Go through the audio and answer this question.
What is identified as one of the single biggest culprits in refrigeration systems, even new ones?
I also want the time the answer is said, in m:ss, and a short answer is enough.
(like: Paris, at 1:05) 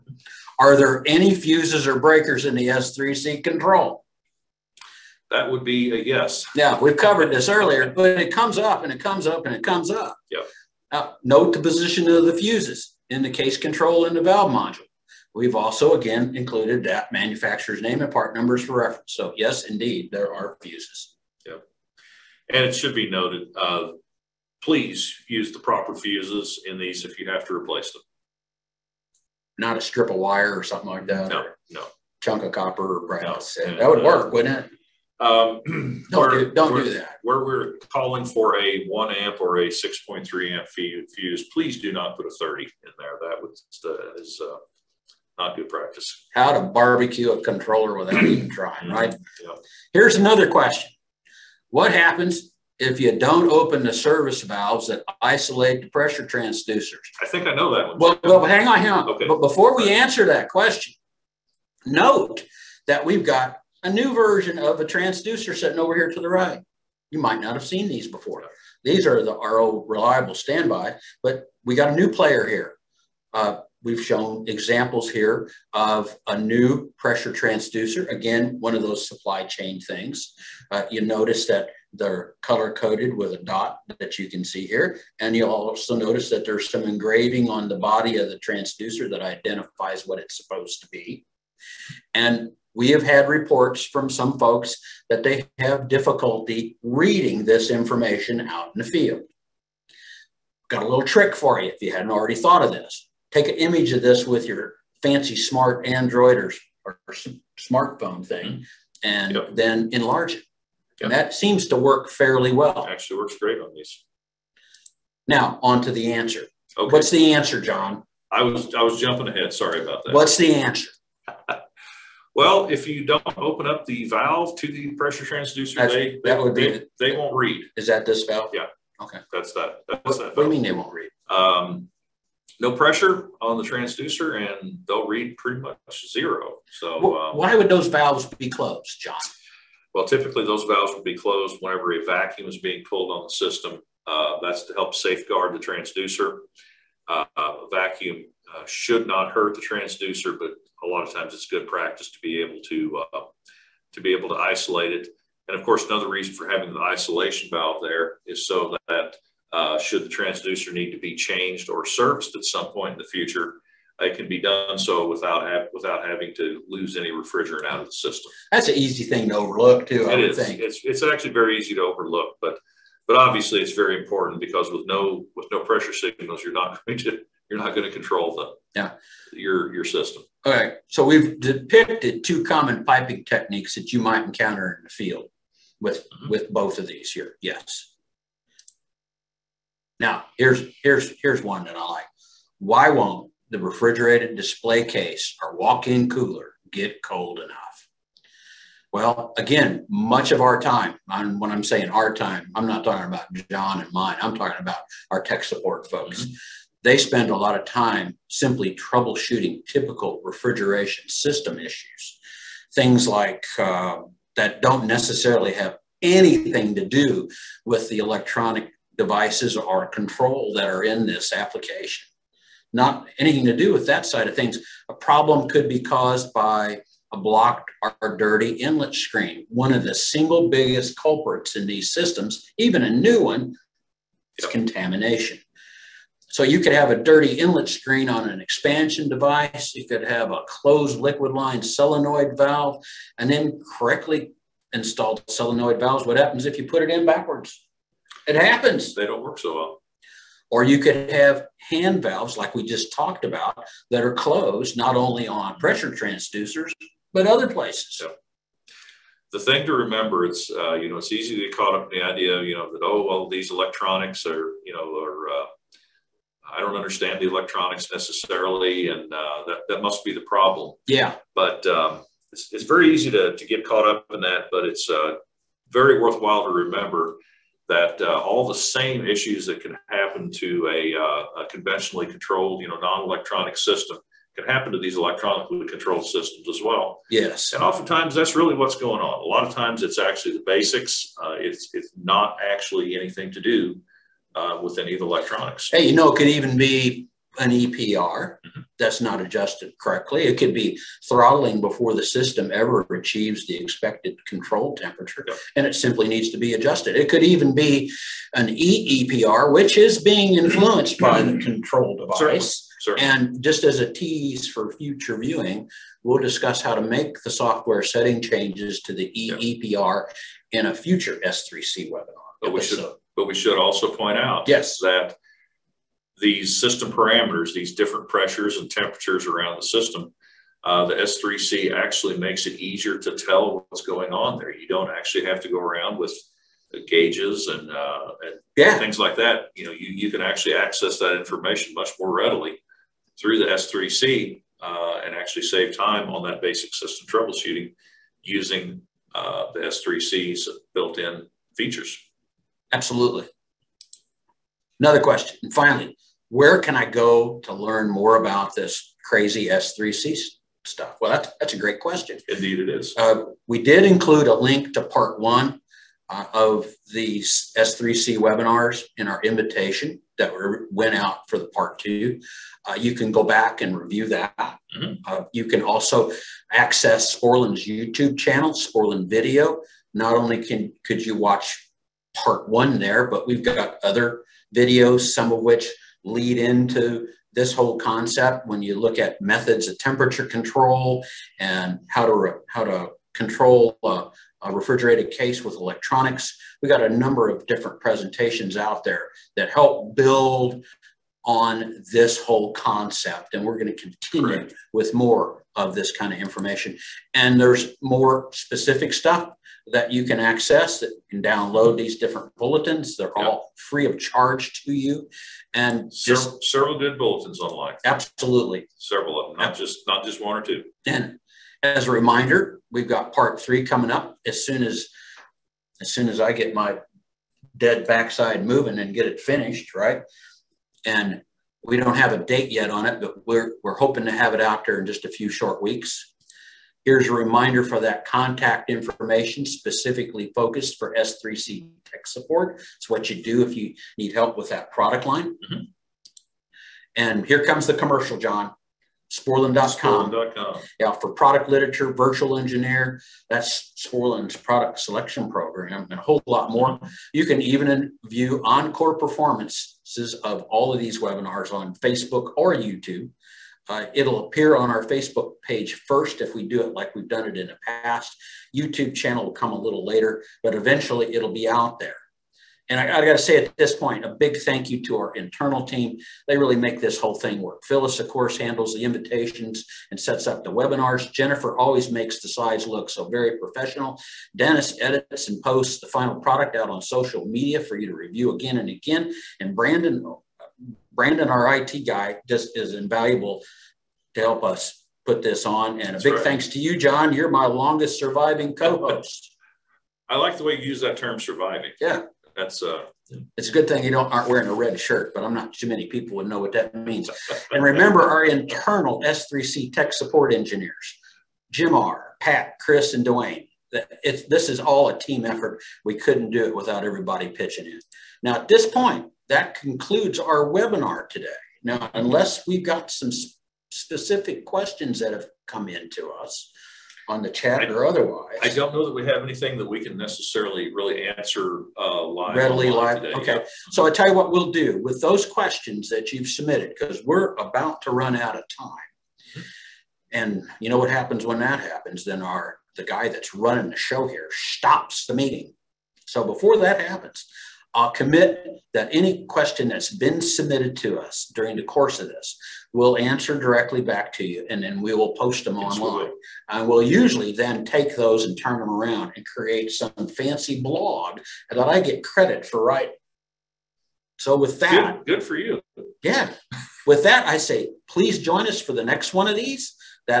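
contamination, at 3:54.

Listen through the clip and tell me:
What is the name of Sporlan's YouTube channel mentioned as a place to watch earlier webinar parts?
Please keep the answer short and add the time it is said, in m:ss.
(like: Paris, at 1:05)
Sporlan Video, at 6:18.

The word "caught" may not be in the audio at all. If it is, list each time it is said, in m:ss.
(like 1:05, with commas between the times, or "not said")
4:21, 4:33.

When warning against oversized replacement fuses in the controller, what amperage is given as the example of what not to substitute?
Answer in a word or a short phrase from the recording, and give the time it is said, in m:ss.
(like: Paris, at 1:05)
30, at 0:42.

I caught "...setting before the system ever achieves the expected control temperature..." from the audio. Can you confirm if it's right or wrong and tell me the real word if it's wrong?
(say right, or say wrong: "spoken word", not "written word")
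wrong: "throttling", not "setting".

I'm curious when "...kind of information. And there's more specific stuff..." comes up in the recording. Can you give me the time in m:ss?
6:45.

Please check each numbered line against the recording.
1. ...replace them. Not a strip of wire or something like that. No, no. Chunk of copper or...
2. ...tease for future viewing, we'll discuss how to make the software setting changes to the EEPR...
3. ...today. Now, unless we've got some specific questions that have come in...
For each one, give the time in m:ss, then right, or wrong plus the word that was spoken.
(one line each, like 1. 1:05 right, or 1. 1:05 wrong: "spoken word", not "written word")
1. 0:27 right
2. 5:13 right
3. 8:41 right.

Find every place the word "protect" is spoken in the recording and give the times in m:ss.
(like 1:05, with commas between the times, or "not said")
not said.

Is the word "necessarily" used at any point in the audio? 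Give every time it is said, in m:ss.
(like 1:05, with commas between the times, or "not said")
3:34, 4:27, 8:49.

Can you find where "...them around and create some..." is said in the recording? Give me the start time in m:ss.
9:18.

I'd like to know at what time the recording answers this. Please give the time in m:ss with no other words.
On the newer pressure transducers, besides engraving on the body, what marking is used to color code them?
1:23.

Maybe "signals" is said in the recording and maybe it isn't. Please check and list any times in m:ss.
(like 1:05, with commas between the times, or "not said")
2:55.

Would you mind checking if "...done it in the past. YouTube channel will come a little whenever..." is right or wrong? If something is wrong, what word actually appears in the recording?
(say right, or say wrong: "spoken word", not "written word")
wrong: "later", not "whenever".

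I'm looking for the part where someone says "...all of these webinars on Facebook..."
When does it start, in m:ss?
7:40.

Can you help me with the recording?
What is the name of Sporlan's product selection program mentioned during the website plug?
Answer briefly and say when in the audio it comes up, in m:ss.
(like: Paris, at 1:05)
virtual engineer, at 7:31.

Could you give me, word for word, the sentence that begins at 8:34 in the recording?
It's, this is all a team effort.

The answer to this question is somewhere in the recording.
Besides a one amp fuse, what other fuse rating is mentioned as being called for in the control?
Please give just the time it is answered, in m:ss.
0:39.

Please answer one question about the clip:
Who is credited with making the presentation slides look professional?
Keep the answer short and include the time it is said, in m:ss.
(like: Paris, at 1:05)
Jennifer, at 8:01.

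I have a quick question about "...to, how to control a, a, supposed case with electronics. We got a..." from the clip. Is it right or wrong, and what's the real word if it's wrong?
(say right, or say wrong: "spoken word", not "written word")
wrong: "refrigerated", not "supposed".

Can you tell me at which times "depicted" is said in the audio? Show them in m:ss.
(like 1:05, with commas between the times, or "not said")
3:01.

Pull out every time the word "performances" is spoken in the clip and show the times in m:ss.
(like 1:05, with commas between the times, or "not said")
7:38.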